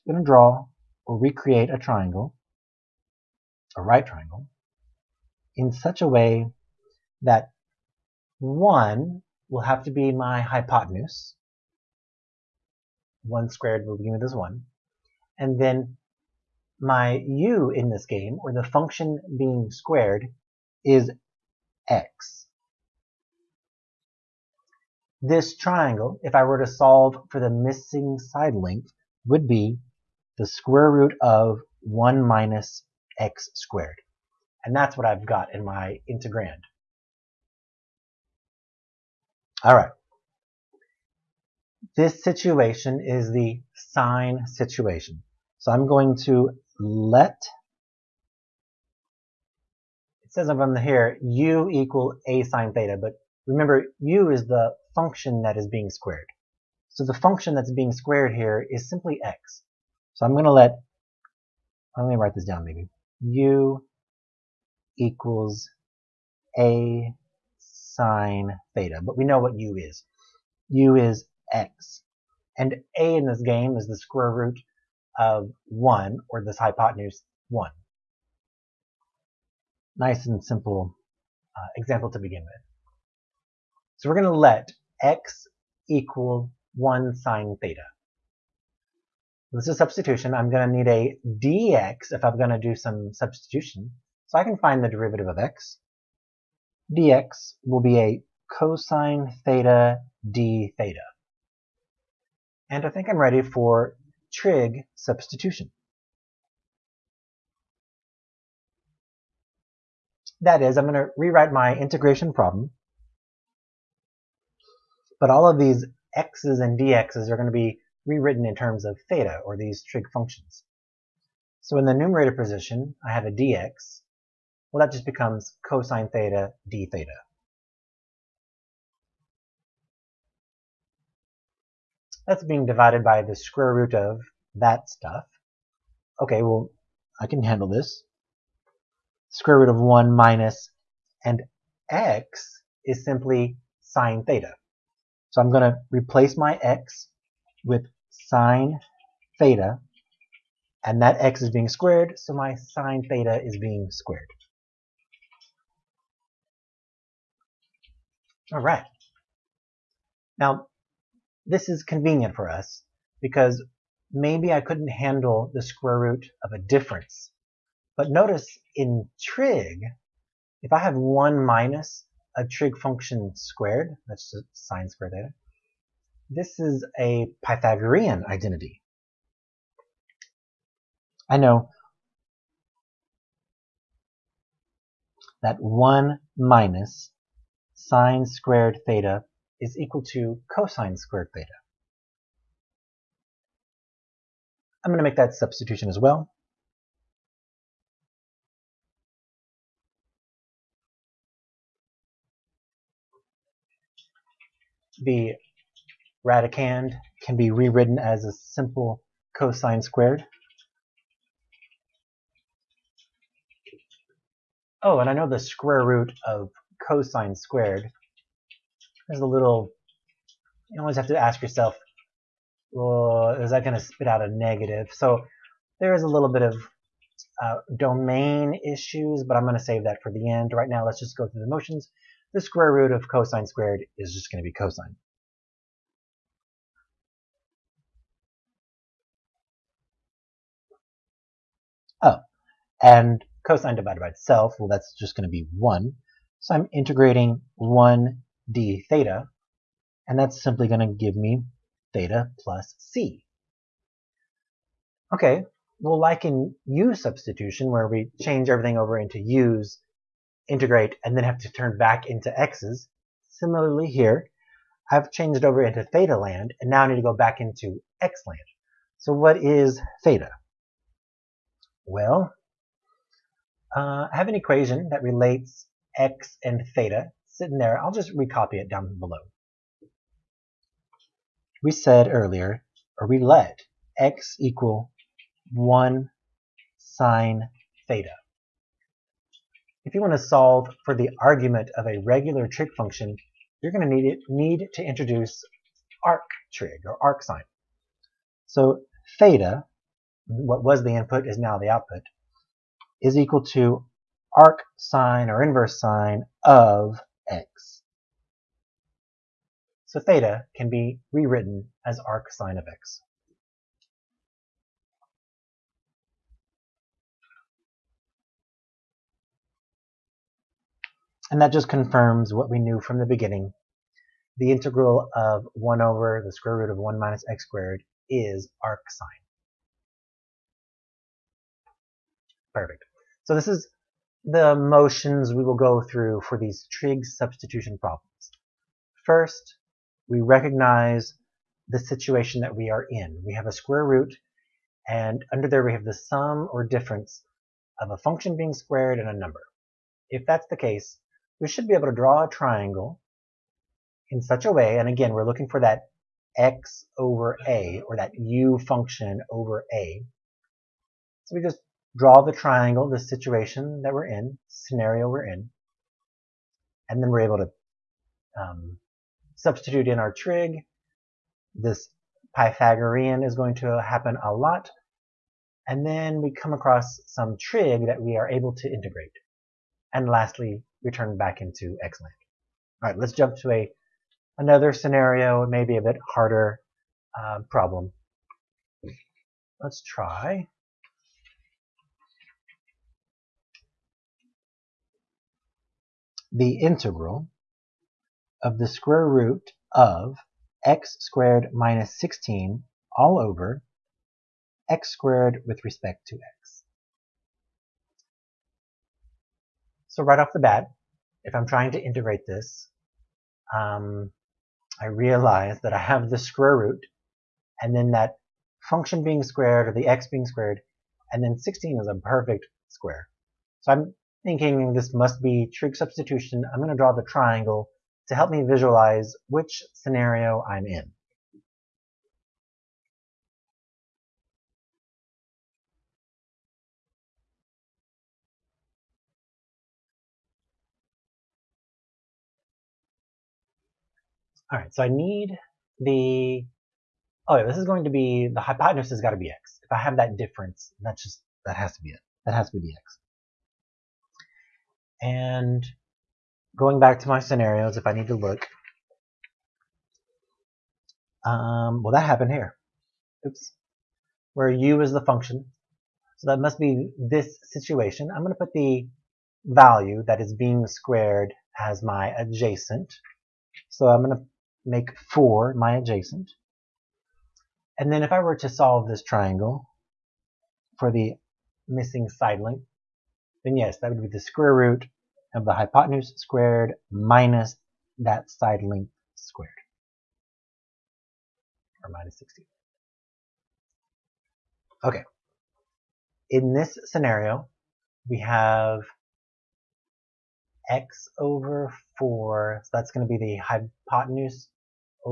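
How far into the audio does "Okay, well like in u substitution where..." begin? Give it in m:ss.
4:15.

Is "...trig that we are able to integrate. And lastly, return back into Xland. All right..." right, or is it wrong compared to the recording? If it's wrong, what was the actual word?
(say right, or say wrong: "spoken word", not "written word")
right.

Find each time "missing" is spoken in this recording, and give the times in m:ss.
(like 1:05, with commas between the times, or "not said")
0:27, 8:01.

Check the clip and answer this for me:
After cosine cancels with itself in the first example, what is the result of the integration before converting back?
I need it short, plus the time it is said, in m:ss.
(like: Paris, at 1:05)
theta plus c, at 4:11.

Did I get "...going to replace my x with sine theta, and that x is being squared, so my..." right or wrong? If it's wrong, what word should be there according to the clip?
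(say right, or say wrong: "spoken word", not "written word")
right.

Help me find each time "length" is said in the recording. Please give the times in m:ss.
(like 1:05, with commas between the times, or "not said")
0:28, 8:02, 8:08.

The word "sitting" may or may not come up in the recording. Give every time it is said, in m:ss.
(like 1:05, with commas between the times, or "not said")
4:37.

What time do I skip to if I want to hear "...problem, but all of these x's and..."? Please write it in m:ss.
1:52.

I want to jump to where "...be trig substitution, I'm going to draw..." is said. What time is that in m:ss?
7:05.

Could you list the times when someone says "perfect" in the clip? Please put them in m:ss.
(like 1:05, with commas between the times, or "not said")
5:32, 7:01.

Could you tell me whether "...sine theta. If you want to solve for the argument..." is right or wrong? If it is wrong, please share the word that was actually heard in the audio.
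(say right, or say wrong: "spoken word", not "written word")
right.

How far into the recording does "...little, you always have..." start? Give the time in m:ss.
3:39.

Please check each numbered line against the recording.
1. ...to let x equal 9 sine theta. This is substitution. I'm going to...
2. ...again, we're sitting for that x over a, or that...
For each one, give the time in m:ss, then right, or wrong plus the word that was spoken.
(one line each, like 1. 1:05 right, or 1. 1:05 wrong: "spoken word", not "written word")
1. 1:24 wrong: "1", not "9"
2. 5:54 wrong: "looking", not "sitting".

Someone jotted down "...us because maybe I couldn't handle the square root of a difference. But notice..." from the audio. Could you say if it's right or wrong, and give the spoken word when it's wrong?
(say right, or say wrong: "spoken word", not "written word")
right.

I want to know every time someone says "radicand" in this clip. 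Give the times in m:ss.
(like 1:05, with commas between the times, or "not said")
3:26.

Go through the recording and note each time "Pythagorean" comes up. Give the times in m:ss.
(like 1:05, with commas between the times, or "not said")
2:57, 6:12.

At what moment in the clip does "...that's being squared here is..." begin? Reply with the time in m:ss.
0:57.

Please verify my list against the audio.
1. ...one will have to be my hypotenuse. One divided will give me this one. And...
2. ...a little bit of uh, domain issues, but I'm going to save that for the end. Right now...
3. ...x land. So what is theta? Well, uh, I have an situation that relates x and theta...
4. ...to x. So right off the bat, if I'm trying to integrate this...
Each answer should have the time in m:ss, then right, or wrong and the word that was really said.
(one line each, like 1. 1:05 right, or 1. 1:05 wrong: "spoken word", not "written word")
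1. 0:08 wrong: "squared", not "divided"
2. 3:46 right
3. 4:27 wrong: "equation", not "situation"
4. 6:46 right.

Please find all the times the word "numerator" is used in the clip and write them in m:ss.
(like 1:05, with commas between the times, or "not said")
2:01.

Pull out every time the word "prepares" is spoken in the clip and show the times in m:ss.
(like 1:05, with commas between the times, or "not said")
not said.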